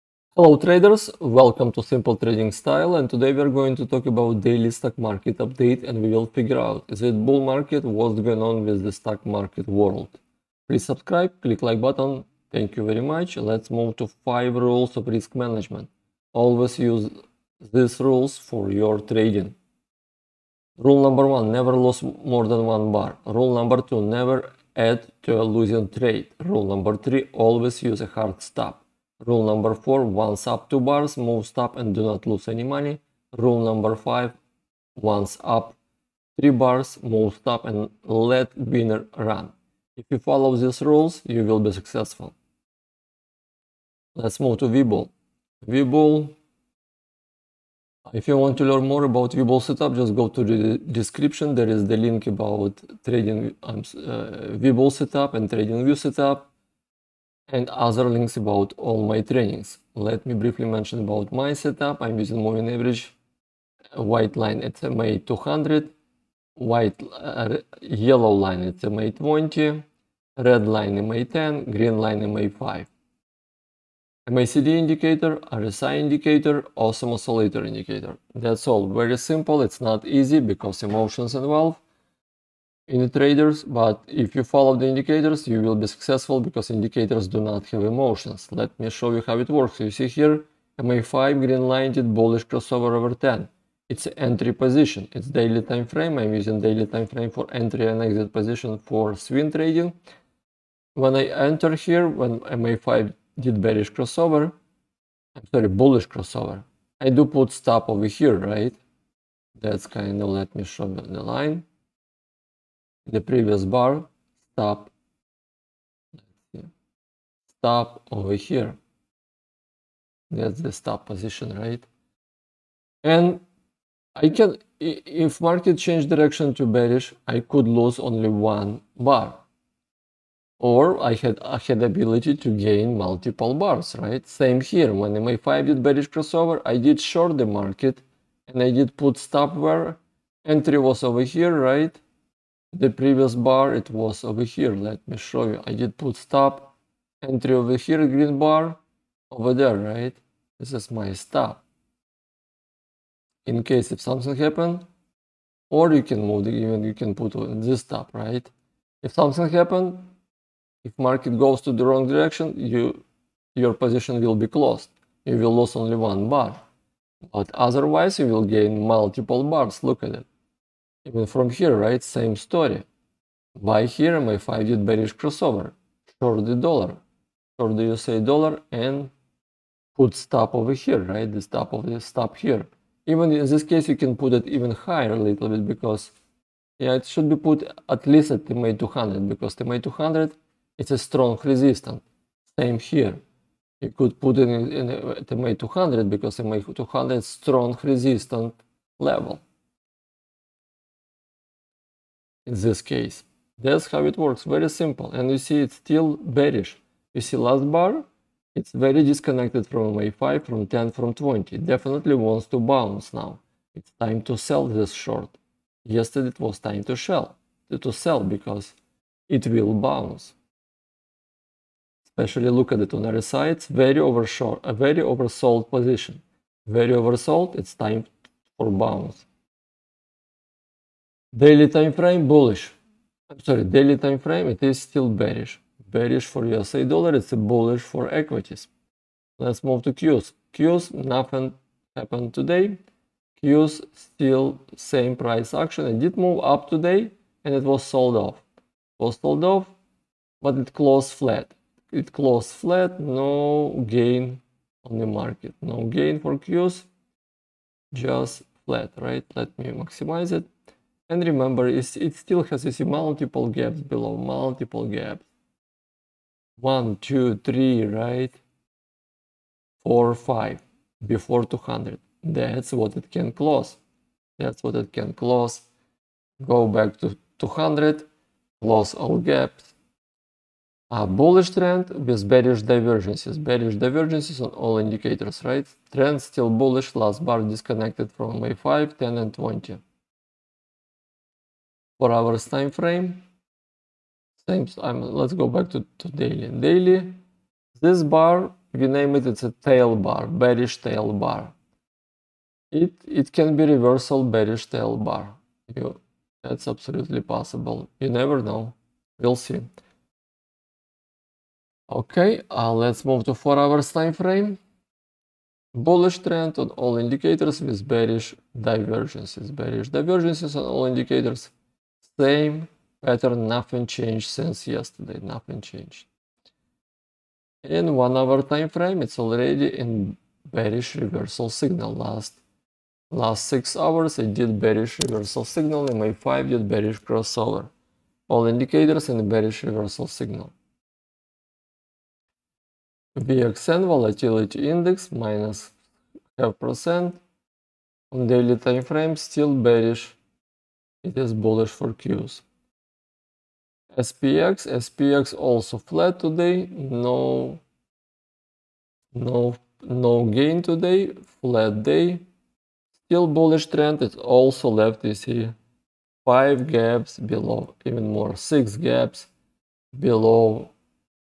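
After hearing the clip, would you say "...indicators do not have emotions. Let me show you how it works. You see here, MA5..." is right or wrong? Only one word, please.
right.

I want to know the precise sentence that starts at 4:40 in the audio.
A bullish trend with bearish divergences.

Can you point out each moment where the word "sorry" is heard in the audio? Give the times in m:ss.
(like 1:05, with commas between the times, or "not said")
1:45, 3:53.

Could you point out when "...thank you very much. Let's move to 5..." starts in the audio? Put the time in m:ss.
0:12.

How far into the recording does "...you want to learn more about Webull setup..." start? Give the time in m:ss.
0:48.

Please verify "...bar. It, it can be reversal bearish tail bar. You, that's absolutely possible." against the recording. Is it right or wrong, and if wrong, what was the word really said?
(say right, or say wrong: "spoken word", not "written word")
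right.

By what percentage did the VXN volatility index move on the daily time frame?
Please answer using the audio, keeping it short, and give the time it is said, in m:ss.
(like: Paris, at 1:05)
Minus 0.5%, at 5:45.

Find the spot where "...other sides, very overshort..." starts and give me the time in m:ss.
3:43.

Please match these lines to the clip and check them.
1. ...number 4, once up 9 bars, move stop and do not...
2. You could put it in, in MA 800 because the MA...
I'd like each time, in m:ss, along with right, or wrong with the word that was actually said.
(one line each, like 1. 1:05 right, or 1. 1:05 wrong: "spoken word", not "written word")
1. 0:29 wrong: "2", not "9"
2. 3:13 wrong: "200", not "800".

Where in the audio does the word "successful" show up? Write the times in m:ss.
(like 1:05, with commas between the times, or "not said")
0:41, 1:25.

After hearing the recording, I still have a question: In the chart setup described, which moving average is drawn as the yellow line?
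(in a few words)
MA 20.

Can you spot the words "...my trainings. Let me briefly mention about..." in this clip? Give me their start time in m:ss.
0:59.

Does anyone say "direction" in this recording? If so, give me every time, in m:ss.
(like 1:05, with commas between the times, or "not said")
2:06, 2:42.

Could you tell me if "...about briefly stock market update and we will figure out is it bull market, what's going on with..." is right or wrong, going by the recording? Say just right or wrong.
wrong.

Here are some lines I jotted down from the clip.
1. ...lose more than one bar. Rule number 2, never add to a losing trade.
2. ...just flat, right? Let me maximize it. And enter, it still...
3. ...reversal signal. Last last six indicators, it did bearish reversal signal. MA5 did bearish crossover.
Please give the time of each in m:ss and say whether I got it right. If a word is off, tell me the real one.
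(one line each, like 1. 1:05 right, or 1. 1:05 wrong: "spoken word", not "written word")
1. 0:21 right
2. 4:17 wrong: "remember", not "enter"
3. 5:30 wrong: "hours", not "indicators".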